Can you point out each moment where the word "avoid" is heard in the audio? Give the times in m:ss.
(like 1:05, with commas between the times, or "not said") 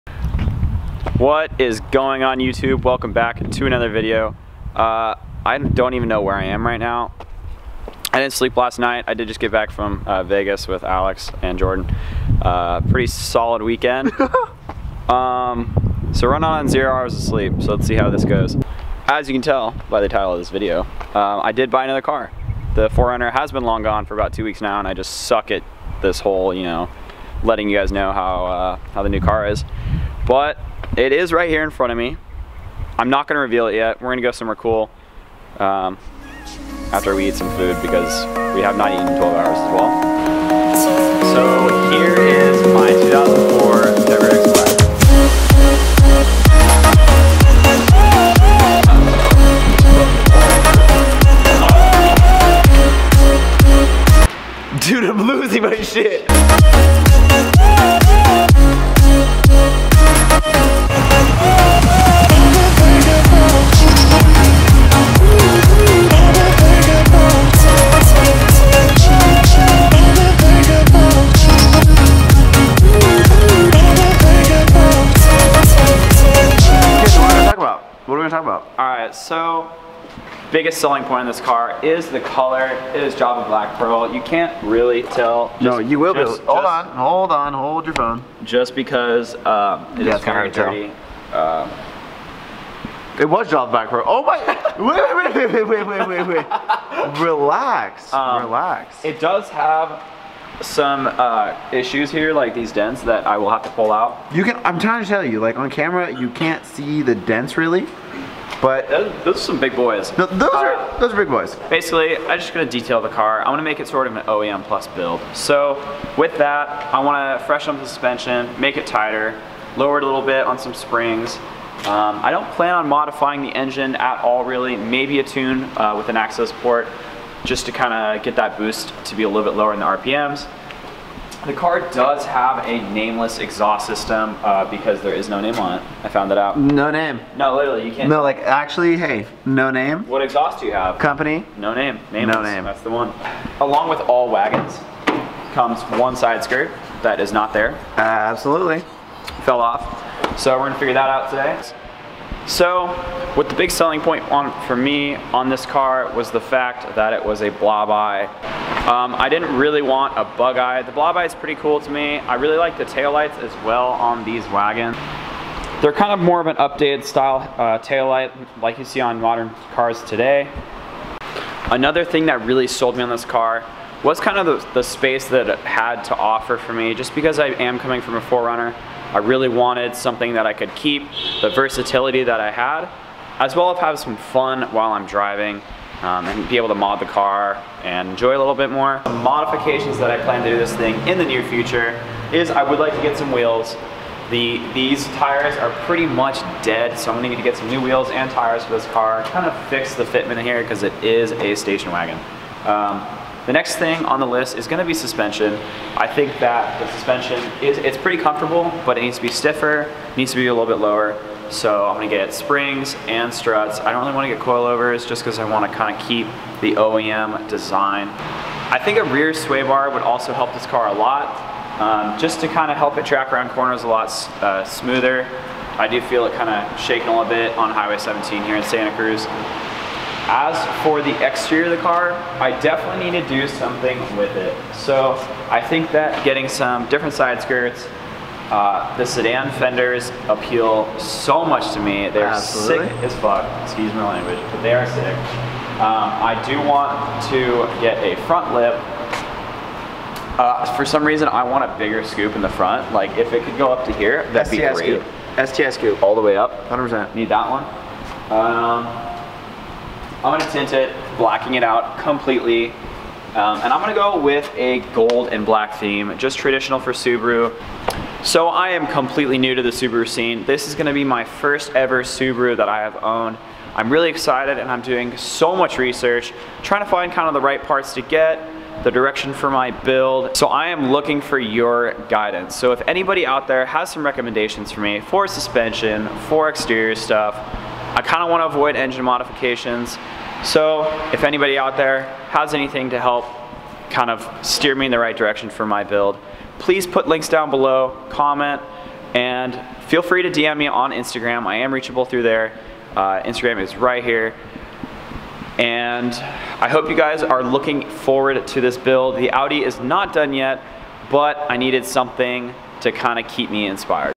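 4:48.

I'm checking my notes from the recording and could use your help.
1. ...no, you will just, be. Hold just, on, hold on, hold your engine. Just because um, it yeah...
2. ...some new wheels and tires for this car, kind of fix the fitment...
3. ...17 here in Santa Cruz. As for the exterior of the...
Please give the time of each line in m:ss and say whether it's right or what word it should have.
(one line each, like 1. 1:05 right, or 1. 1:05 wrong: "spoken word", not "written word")
1. 1:25 wrong: "phone", not "engine"
2. 3:17 right
3. 3:47 right.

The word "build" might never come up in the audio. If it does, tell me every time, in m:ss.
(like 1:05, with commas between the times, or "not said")
1:54, 4:39, 4:55, 5:08.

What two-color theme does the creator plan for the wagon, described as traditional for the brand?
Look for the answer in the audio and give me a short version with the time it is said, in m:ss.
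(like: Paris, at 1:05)
gold and black, at 4:24.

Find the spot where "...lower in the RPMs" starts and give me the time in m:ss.
2:09.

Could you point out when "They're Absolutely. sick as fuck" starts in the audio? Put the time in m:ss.
4:02.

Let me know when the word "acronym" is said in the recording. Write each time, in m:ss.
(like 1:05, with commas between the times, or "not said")
not said.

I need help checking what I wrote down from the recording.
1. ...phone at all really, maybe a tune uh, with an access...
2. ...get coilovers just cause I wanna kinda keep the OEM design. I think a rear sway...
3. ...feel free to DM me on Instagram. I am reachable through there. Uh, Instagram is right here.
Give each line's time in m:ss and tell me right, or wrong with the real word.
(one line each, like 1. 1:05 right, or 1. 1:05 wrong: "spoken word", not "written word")
1. 2:03 wrong: "engine", not "phone"
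2. 3:34 right
3. 4:59 right.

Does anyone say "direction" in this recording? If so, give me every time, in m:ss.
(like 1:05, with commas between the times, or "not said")
4:38, 4:55.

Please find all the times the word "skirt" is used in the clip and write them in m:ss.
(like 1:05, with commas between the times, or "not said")
2:26, 3:57.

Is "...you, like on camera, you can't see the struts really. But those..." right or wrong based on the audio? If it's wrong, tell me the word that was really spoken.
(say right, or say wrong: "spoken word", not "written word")
wrong: "dents", not "struts".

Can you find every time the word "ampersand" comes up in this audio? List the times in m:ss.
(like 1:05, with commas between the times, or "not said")
not said.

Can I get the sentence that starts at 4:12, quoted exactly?
Like, if it could go up to here, that'd STS be great.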